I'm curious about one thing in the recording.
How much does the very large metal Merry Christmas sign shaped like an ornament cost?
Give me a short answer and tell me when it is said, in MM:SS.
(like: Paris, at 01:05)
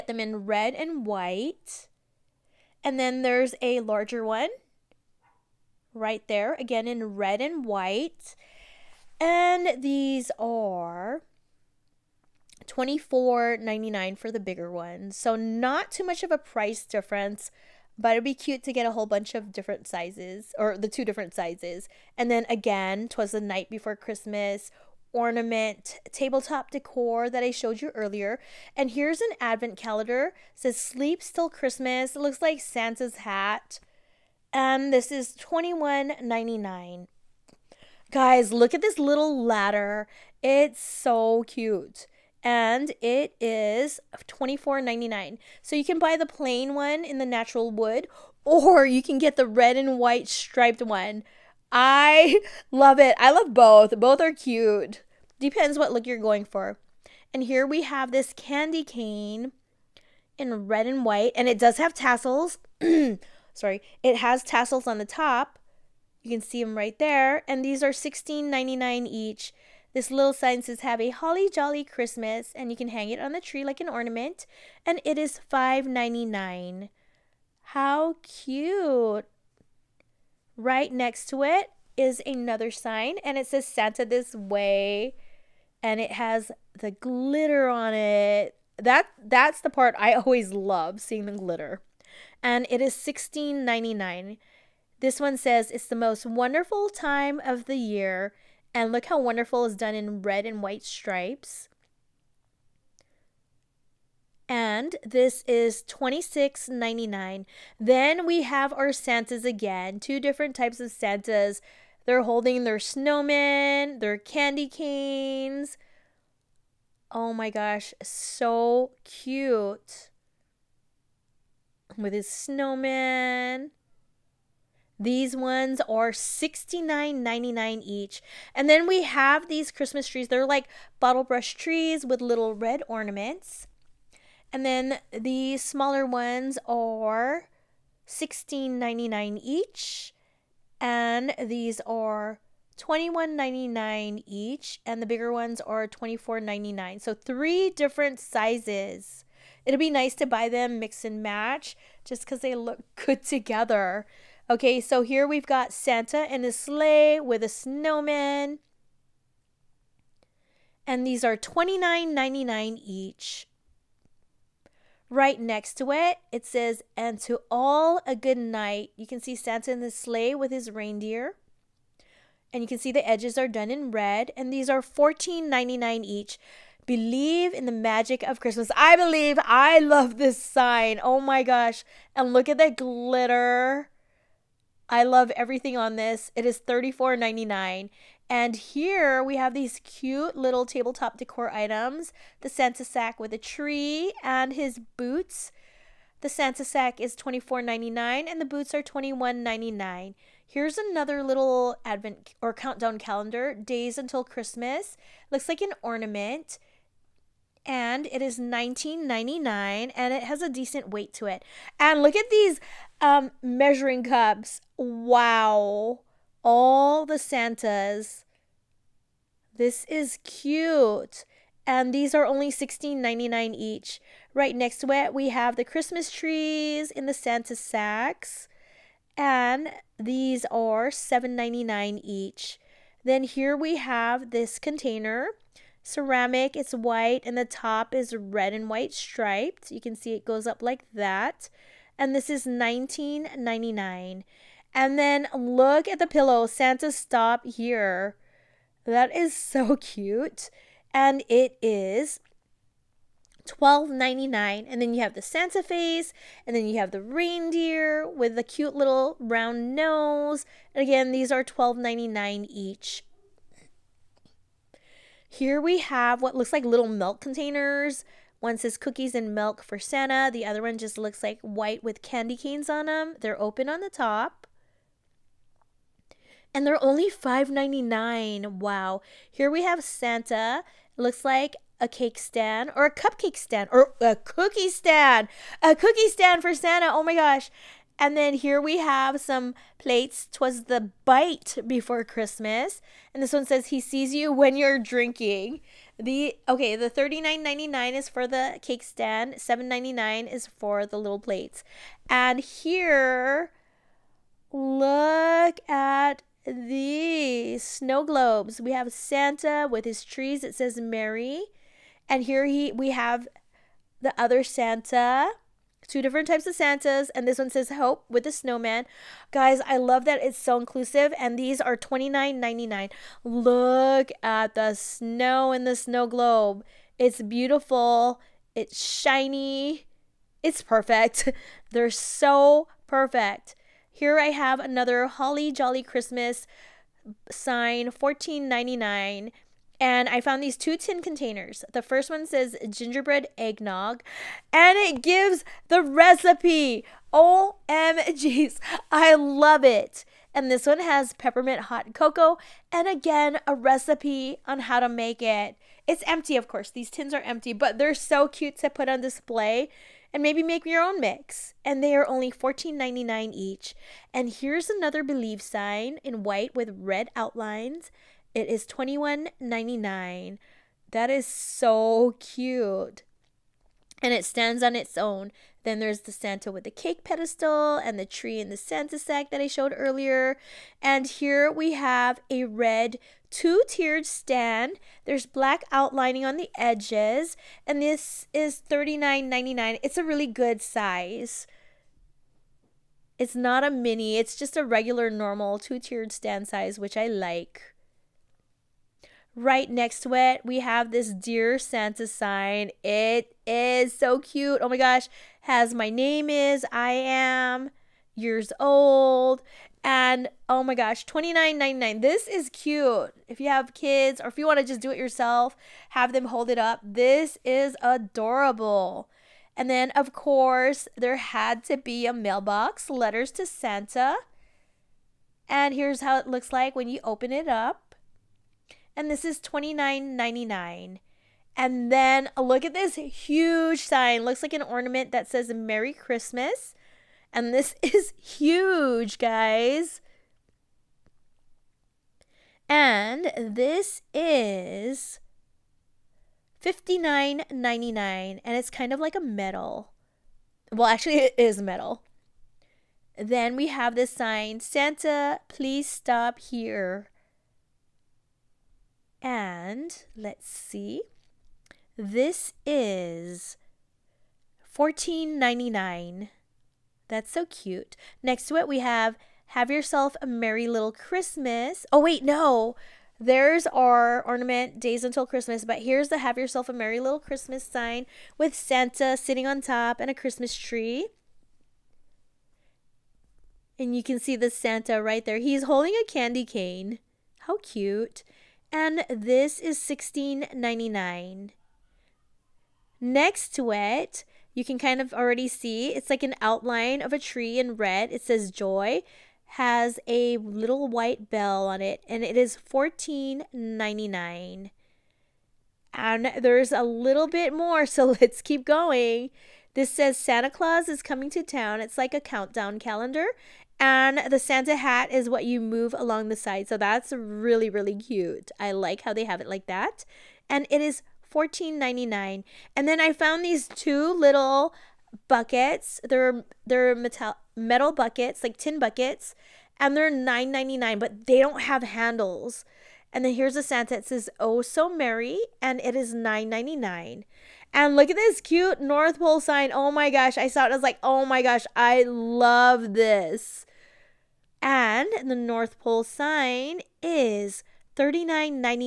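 $59.99, at 07:26.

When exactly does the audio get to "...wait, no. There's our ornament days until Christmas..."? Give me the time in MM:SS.
07:52.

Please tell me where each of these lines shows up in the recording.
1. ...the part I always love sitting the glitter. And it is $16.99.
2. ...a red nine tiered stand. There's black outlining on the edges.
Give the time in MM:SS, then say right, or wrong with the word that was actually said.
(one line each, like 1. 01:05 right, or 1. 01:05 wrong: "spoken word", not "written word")
1. 01:29 wrong: "seeing", not "sitting"
2. 06:22 wrong: "two", not "nine".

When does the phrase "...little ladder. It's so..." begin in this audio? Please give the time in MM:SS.
00:38.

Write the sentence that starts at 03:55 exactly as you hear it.
Ceramic, it's white, and the top is red and white striped.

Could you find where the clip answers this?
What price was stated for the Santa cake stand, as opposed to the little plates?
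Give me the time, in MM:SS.
04:56.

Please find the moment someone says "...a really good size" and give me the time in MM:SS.
06:29.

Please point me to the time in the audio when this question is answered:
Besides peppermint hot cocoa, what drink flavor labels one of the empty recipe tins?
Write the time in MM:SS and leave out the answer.
05:42.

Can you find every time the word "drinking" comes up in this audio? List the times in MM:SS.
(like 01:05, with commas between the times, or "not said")
04:54.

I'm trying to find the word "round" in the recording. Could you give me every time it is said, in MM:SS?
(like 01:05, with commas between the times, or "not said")
04:19.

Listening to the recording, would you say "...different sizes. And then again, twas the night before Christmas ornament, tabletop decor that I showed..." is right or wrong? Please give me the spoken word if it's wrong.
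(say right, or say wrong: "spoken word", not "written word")
right.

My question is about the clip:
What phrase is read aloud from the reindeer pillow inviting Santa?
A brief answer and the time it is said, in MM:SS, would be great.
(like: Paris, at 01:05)
Santa stop here, at 04:06.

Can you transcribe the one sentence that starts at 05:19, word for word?
Guys, I love that it's so inclusive, and these are $29.99.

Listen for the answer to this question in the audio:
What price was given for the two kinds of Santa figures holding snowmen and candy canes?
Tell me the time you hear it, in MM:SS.
02:06.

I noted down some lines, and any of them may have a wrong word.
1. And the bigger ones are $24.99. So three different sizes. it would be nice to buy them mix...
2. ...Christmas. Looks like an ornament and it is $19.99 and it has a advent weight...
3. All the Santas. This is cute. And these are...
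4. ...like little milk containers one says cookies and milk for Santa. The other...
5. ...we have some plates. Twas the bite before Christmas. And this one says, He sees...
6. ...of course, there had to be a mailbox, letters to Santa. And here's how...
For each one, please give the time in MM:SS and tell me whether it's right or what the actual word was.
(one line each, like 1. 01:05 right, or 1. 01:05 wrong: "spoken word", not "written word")
1. 02:24 right
2. 03:24 wrong: "decent", not "advent"
3. 03:36 right
4. 04:26 right
5. 04:48 right
6. 06:59 right.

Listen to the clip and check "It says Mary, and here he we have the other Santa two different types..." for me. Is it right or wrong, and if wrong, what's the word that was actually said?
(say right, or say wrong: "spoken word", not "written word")
right.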